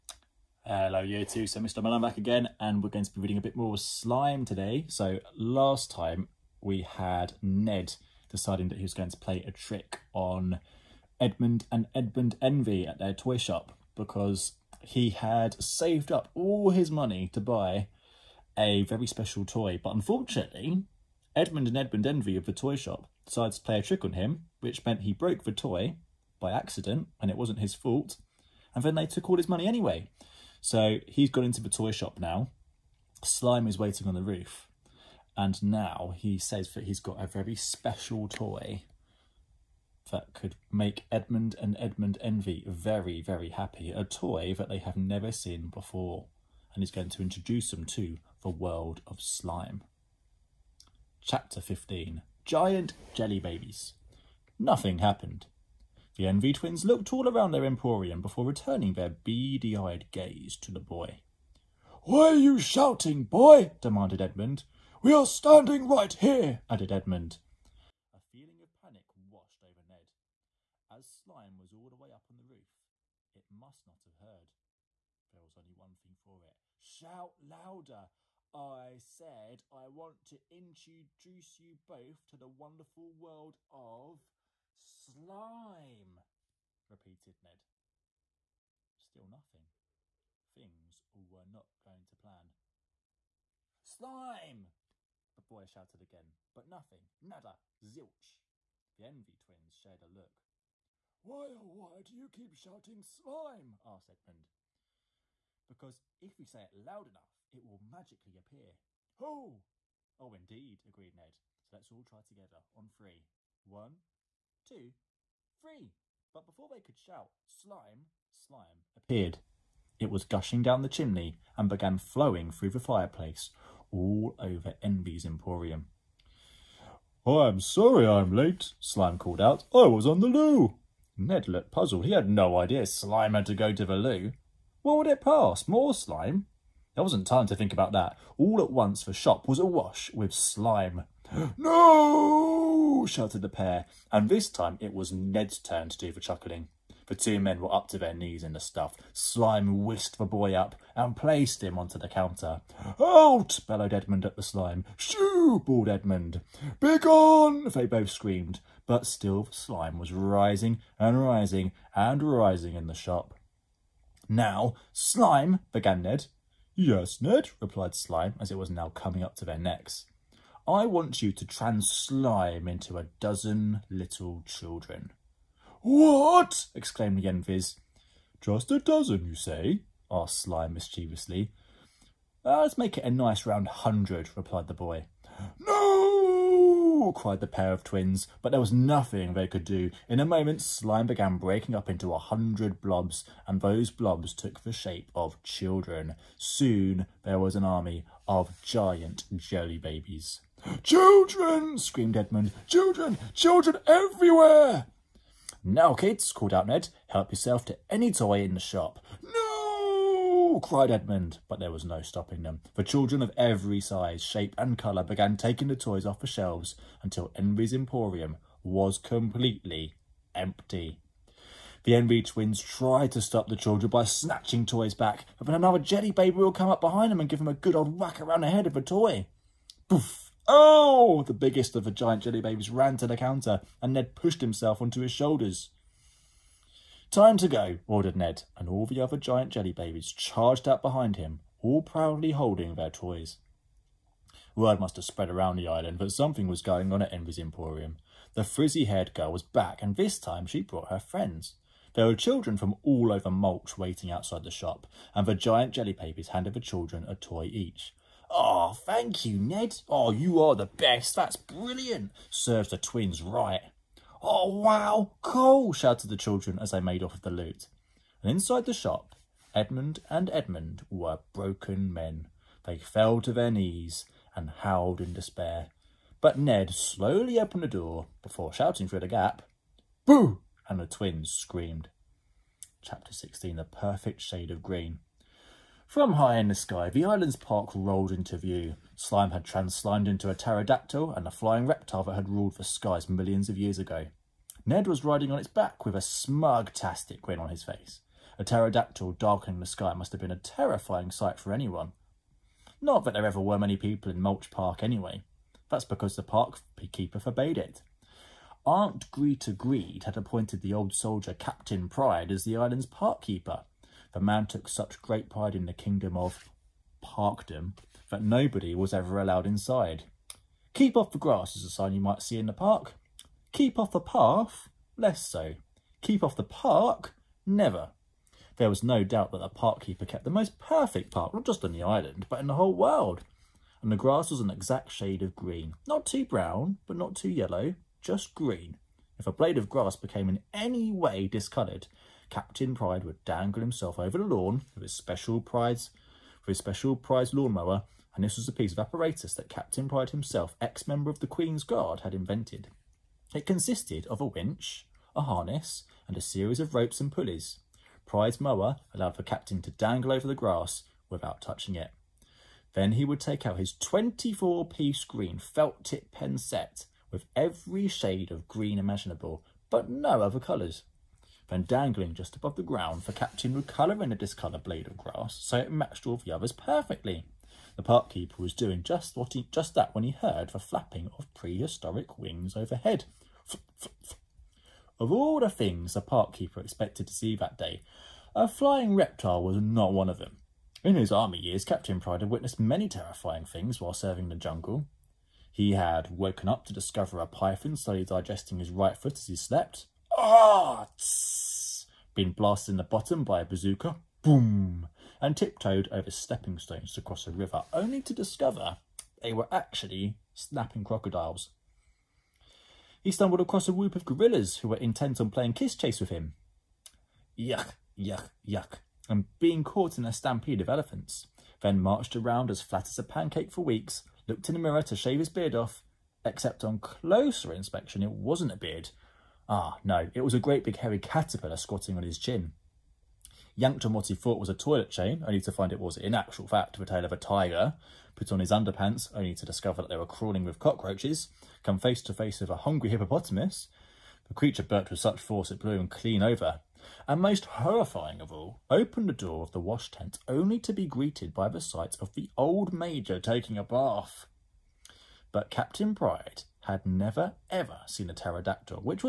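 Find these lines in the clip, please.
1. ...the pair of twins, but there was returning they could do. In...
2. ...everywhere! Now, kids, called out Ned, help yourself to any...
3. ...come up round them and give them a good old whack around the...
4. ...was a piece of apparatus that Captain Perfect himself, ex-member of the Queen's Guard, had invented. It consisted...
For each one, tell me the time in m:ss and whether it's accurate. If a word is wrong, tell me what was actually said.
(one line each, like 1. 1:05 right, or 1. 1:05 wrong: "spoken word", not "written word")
1. 3:07 wrong: "nothing", not "returning"
2. 3:23 right
3. 3:46 wrong: "behind", not "round"
4. 5:48 wrong: "Pride", not "Perfect".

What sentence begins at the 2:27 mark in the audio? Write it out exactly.
The two men were up to their knees in the stuff.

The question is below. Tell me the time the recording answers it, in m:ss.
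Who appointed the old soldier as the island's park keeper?
5:08.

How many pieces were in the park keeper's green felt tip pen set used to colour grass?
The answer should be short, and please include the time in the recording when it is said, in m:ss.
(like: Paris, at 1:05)
24, at 6:03.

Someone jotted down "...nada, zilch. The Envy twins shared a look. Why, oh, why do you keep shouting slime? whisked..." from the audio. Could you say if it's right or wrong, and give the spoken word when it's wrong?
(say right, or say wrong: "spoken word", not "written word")
wrong: "asked", not "whisked".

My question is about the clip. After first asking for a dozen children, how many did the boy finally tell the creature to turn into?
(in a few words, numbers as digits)
100.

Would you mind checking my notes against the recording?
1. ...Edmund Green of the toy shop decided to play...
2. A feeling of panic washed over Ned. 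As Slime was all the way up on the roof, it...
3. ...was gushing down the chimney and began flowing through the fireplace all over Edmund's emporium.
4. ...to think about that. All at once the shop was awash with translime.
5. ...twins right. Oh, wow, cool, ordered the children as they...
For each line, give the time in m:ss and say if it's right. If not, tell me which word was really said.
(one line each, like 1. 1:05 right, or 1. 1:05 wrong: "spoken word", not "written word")
1. 0:21 wrong: "Envy", not "Green"
2. 1:08 right
3. 2:00 wrong: "Envy", not "Edmund"
4. 2:17 wrong: "slime", not "translime"
5. 4:22 wrong: "shouted", not "ordered".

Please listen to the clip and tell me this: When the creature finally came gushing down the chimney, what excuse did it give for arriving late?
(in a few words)
On the loo.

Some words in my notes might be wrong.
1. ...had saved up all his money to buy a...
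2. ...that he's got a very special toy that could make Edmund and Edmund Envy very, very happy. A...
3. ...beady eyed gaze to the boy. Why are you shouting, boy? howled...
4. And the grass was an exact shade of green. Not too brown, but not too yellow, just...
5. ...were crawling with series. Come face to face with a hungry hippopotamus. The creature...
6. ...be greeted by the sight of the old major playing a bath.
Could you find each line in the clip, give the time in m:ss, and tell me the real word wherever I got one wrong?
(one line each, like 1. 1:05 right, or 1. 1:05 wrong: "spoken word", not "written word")
1. 0:15 right
2. 0:36 right
3. 0:59 wrong: "demanded", not "howled"
4. 5:33 right
5. 7:19 wrong: "cockroaches", not "series"
6. 7:30 wrong: "taking", not "playing".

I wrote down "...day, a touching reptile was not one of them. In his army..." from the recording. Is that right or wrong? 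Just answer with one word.
wrong.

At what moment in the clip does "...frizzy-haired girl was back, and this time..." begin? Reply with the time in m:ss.
4:08.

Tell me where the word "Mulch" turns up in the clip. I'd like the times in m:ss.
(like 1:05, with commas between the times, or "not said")
4:13, 5:04.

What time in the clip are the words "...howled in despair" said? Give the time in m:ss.
4:34.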